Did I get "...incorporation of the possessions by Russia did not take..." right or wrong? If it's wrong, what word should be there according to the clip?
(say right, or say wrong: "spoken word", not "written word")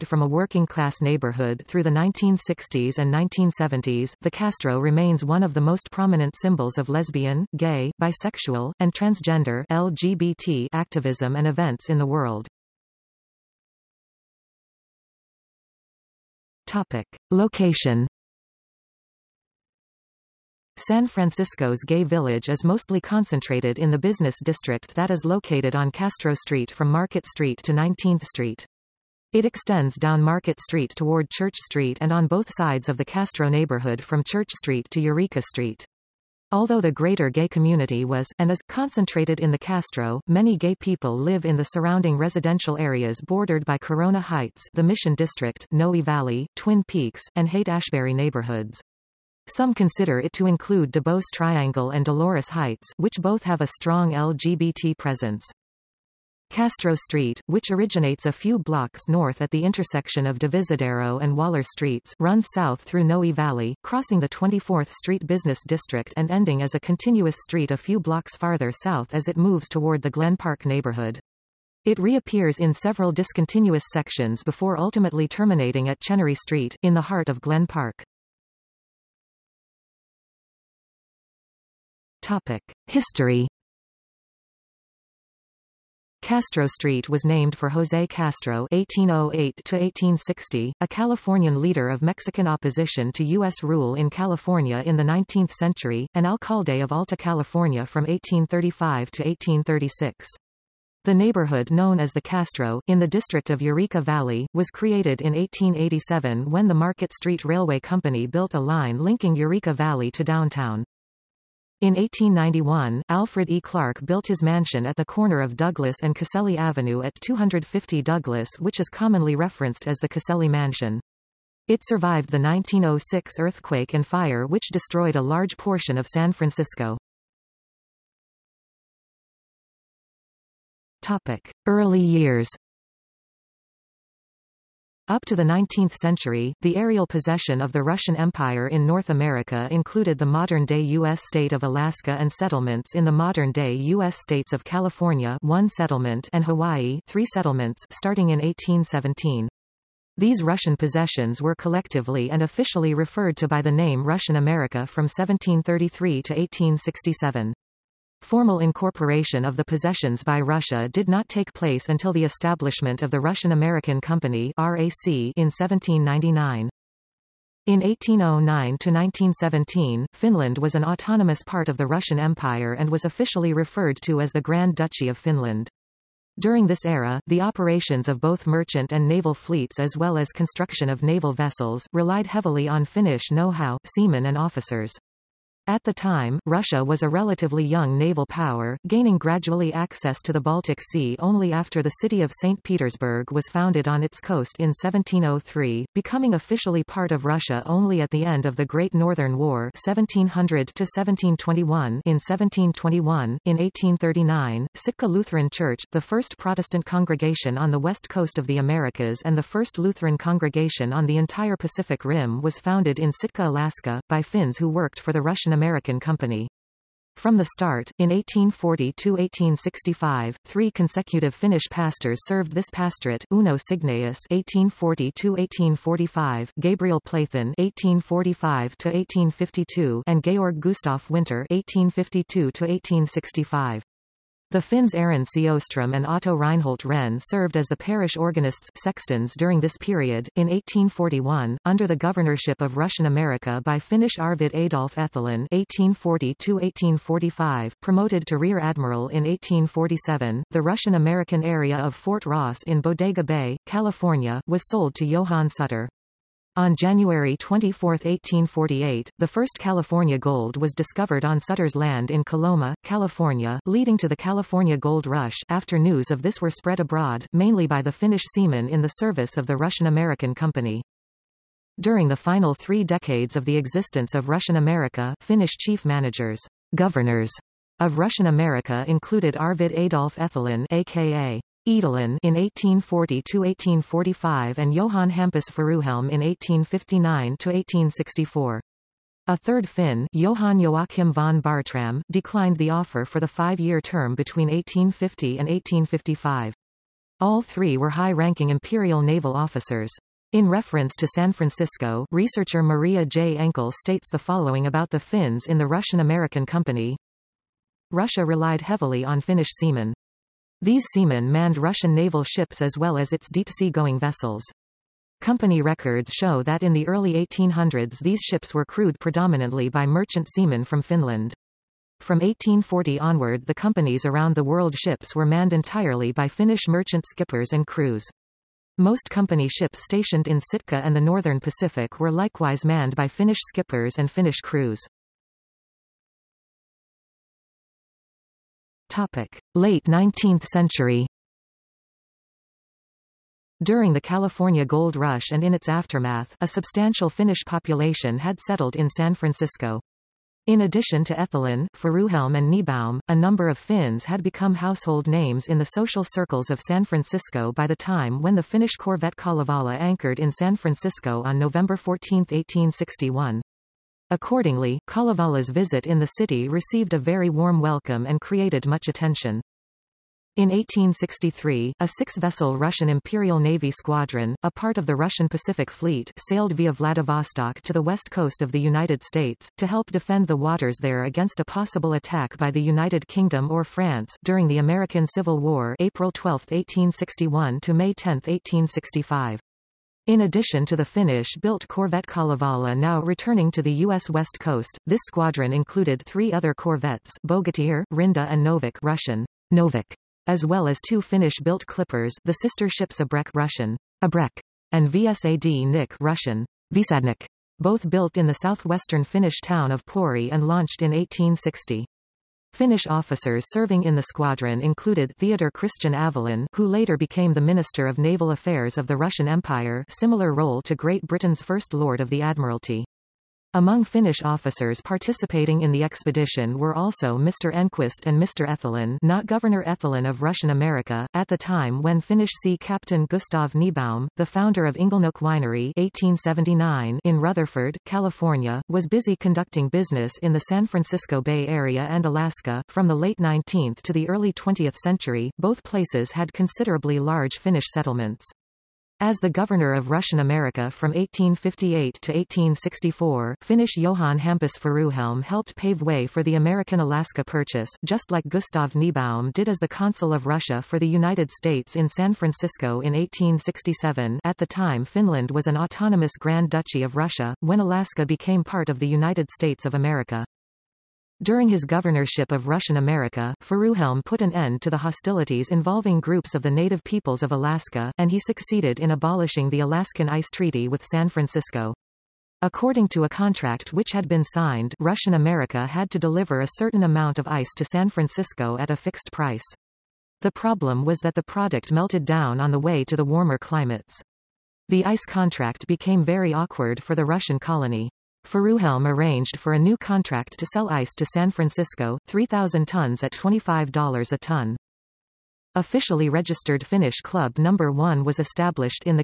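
right.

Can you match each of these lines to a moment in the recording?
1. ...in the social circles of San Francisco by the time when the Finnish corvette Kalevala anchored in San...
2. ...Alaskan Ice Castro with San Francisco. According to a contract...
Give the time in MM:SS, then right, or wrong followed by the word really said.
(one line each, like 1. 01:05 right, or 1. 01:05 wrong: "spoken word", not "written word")
1. 05:55 right
2. 07:59 wrong: "Treaty", not "Castro".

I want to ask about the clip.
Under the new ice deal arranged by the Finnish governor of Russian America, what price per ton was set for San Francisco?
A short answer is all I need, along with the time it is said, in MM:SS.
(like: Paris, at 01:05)
$25, at 08:23.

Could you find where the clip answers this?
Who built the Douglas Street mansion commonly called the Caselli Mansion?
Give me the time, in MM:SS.
01:53.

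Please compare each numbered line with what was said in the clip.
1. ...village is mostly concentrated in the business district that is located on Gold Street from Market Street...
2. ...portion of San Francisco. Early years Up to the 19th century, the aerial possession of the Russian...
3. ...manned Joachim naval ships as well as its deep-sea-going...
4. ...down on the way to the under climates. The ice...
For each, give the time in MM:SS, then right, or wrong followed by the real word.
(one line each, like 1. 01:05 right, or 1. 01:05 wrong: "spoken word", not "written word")
1. 00:22 wrong: "Castro", not "Gold"
2. 02:05 right
3. 05:11 wrong: "Russian", not "Joachim"
4. 08:12 wrong: "warmer", not "under".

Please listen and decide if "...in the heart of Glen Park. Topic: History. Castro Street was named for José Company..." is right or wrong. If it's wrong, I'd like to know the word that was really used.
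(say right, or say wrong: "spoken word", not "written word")
wrong: "Castro", not "Company".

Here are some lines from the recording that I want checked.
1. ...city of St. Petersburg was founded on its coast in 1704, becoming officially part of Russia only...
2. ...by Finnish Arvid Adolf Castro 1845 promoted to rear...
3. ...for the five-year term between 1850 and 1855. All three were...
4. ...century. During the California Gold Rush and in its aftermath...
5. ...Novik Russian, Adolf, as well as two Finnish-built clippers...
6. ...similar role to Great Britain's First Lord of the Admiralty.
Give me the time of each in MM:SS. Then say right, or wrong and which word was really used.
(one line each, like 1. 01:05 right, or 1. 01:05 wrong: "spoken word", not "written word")
1. 03:12 wrong: "1703", not "1704"
2. 04:03 wrong: "Etholén", not "Castro"
3. 04:53 right
4. 05:40 right
5. 06:38 wrong: "Novik", not "Adolf"
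6. 06:59 right.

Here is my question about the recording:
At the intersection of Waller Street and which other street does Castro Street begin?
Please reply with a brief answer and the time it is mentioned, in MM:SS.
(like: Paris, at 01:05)
Divisadero, at 01:00.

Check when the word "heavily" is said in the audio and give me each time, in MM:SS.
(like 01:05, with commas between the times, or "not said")
03:02, 05:08.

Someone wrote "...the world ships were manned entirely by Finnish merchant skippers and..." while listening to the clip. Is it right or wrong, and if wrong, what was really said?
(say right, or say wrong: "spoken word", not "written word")
right.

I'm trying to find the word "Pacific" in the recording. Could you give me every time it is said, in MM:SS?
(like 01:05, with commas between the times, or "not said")
03:31, 05:31, 06:15.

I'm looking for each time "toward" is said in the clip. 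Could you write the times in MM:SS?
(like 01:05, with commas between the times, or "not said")
00:30, 01:09.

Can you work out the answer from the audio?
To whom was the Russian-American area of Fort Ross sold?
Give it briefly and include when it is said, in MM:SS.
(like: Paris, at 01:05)
Johann Sutter, at 04:15.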